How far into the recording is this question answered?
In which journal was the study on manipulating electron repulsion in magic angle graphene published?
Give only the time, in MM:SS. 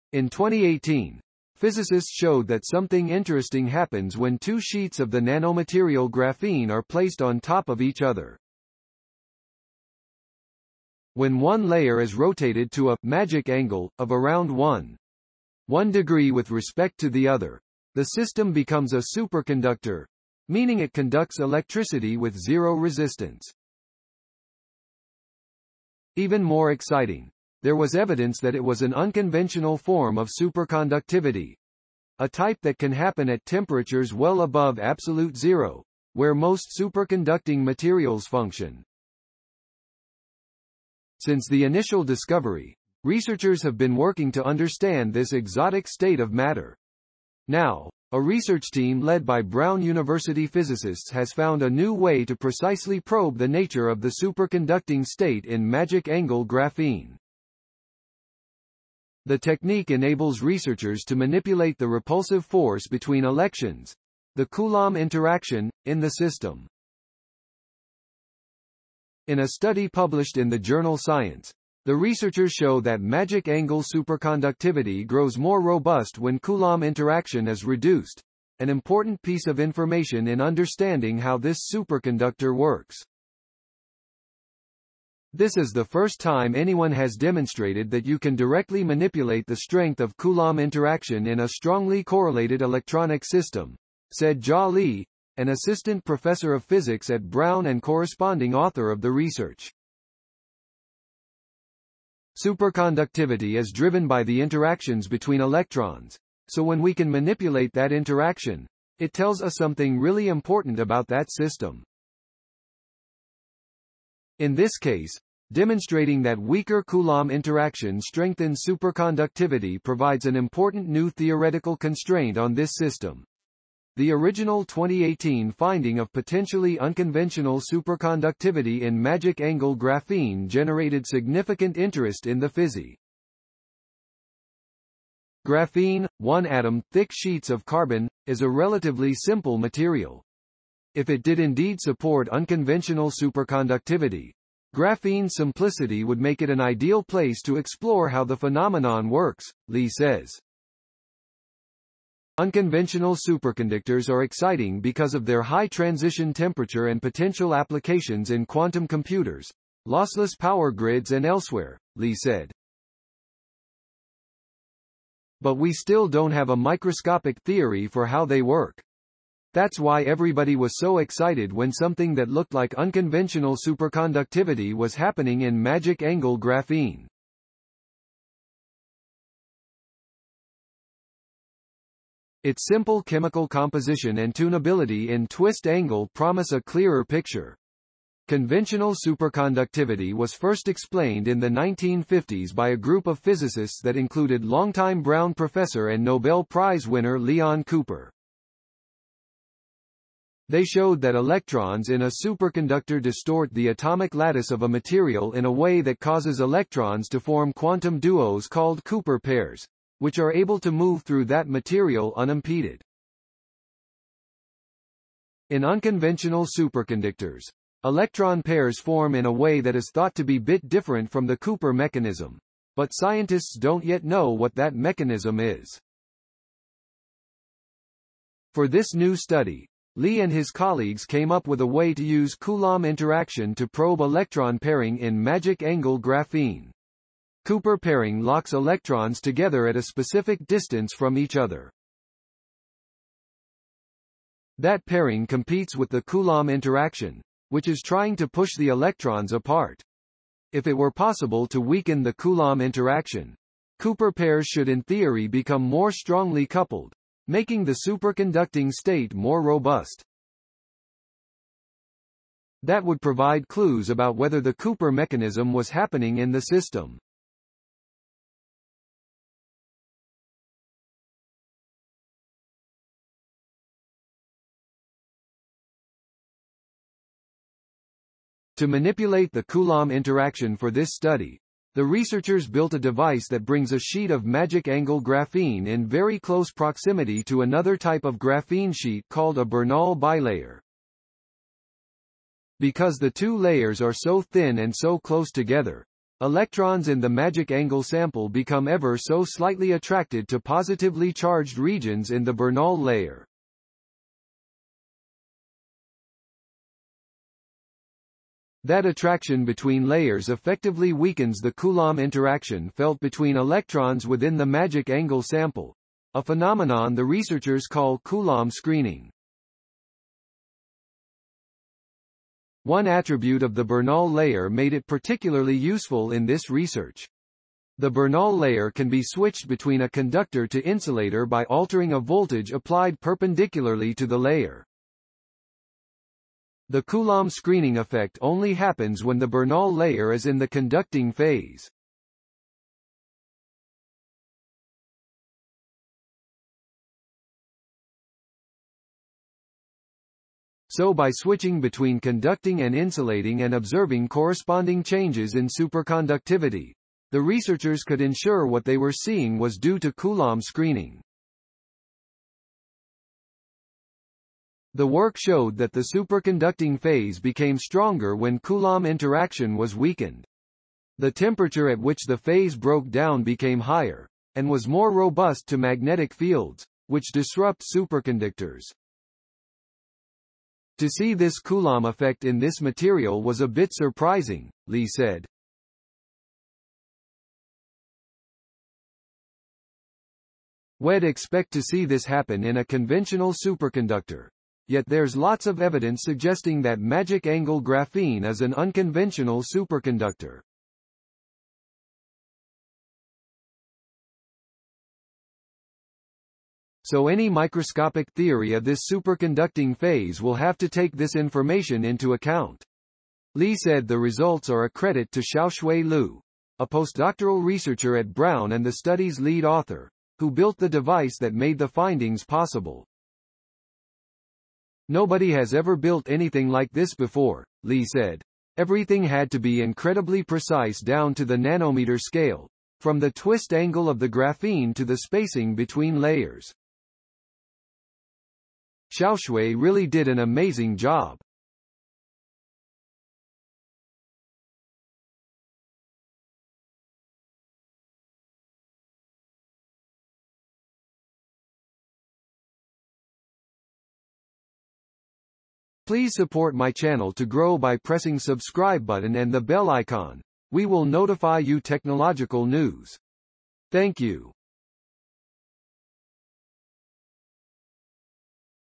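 01:10.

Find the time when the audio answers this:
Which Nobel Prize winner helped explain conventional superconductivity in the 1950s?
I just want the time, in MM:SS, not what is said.
03:17.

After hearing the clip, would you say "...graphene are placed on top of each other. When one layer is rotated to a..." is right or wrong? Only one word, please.
right.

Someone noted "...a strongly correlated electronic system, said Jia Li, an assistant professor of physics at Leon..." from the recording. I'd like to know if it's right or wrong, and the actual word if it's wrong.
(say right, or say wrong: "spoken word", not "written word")
wrong: "Brown", not "Leon".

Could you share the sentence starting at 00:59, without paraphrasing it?
The technique enables researchers to manipulate the repulsive force between elections, the Coulomb interaction, in the system.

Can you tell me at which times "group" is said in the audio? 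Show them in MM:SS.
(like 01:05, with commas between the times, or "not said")
03:12.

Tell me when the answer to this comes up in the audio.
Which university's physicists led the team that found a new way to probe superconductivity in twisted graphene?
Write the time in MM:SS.
00:49.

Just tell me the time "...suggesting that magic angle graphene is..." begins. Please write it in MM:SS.
06:36.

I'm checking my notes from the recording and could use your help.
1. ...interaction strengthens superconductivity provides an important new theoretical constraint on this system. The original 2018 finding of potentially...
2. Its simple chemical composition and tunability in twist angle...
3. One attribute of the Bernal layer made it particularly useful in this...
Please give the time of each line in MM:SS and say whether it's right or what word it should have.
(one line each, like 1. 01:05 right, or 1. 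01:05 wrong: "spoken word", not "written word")
1. 01:57 right
2. 03:02 right
3. 05:22 right.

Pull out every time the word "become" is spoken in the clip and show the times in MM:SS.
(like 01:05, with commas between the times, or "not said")
00:18, 04:15, 04:58.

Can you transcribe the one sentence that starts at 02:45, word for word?
But we still don't have a microscopic theory for how they work.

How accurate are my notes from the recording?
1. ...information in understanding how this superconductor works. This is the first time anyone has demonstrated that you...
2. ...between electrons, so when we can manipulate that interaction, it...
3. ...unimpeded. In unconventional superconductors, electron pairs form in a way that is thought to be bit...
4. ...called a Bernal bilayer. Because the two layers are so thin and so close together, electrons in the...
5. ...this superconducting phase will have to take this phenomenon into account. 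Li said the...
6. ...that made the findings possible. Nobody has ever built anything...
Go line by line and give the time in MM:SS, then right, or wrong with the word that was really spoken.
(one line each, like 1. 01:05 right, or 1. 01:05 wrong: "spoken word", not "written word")
1. 01:19 right
2. 01:45 right
3. 03:32 right
4. 04:49 right
5. 06:48 wrong: "information", not "phenomenon"
6. 07:01 right.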